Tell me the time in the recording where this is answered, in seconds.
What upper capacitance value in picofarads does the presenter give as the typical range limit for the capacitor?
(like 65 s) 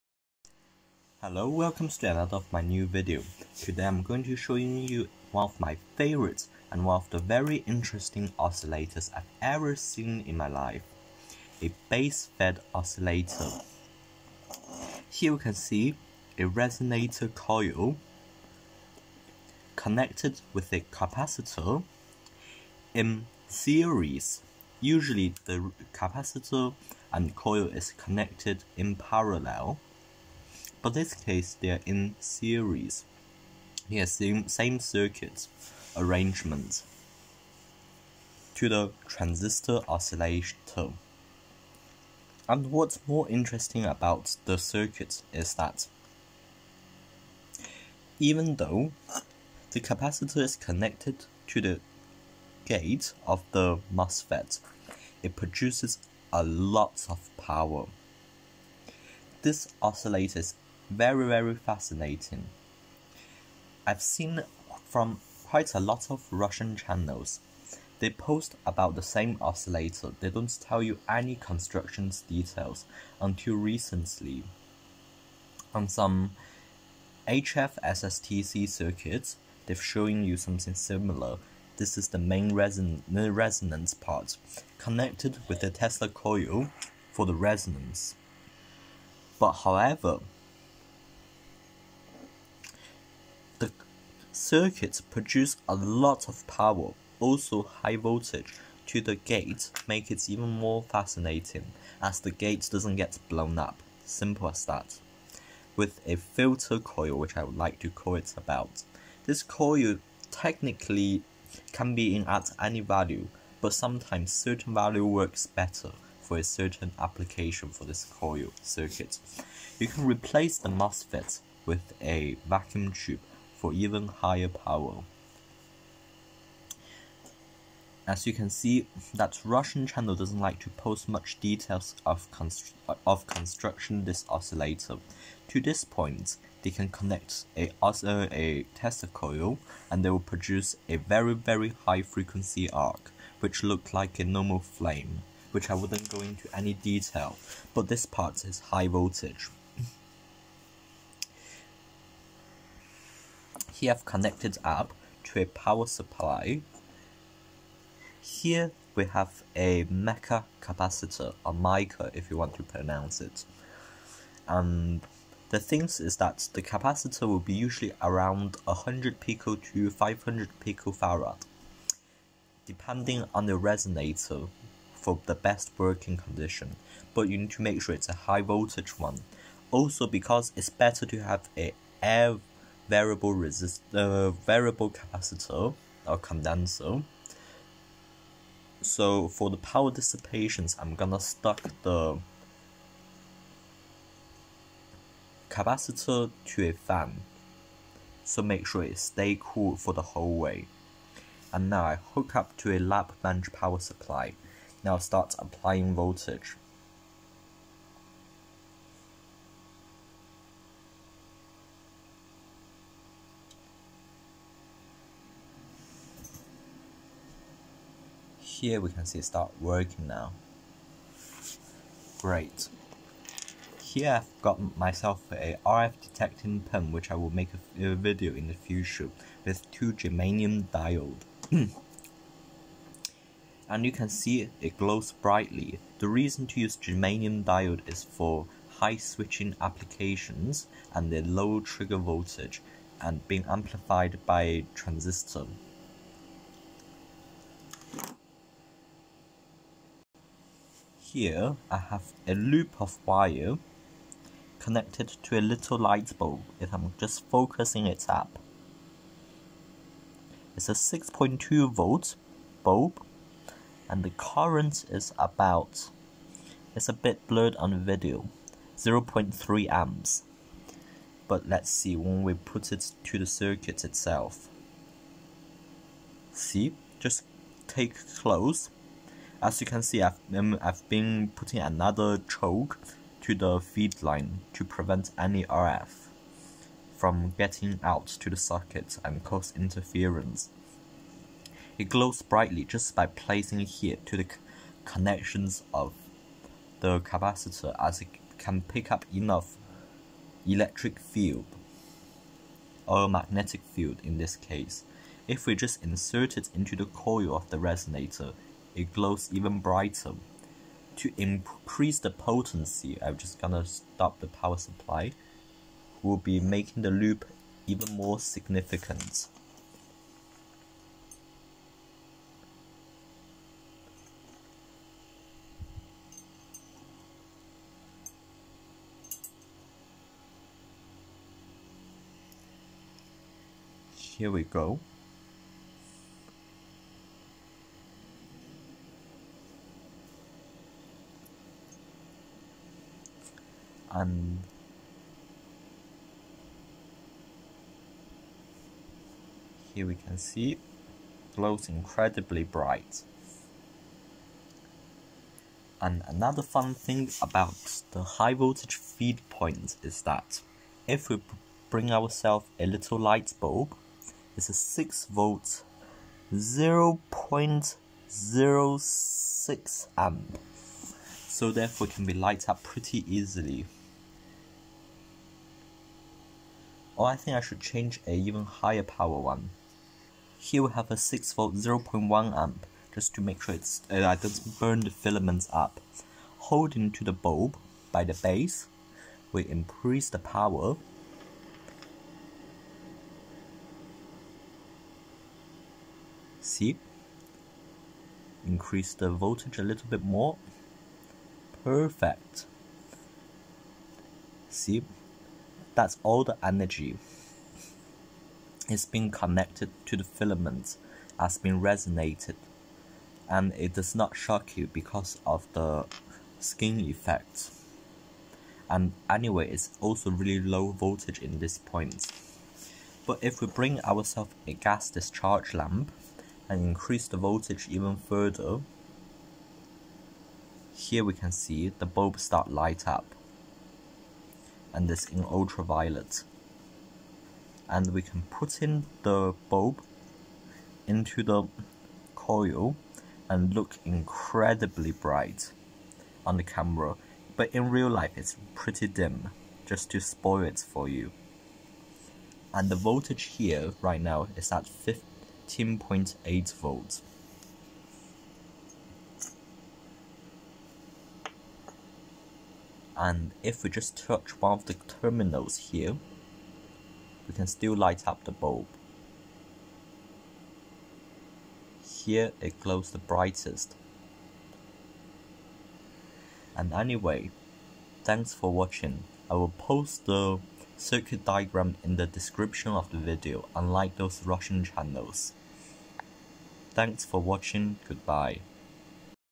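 169 s.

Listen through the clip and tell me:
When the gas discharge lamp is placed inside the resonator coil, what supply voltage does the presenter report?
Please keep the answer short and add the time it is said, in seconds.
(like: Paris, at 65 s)
15.8 volts, at 454 s.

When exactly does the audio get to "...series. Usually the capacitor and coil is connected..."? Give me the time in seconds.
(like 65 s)
23 s.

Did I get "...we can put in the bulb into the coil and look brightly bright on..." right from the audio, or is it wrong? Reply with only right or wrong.
wrong.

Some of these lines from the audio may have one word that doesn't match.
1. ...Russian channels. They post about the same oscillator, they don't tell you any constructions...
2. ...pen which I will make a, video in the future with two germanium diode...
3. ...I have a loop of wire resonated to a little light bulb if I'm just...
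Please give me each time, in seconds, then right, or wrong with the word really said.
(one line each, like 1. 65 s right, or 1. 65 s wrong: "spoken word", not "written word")
1. 66 s right
2. 226 s right
3. 251 s wrong: "connected", not "resonated".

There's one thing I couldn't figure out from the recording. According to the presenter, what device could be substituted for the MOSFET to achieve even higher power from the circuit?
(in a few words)
vacuum tube.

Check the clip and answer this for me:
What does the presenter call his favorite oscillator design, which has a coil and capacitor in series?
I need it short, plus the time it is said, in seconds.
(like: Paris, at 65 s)
base fed oscillator, at 11 s.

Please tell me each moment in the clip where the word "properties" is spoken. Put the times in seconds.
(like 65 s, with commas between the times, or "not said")
not said.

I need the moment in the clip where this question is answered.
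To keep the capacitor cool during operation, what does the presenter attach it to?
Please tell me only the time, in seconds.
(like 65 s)
196 s.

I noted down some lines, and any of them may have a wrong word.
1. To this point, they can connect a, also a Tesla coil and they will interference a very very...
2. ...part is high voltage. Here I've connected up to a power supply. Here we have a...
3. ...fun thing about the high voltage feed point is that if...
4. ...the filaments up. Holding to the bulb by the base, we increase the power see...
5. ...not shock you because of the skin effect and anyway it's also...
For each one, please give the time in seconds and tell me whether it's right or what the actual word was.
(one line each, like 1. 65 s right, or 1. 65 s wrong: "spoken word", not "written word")
1. 135 s wrong: "produce", not "interference"
2. 148 s right
3. 356 s right
4. 384 s right
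5. 413 s right.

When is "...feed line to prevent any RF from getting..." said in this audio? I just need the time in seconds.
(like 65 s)
283 s.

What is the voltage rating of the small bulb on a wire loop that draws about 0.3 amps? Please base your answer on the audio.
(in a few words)
6.2 volts.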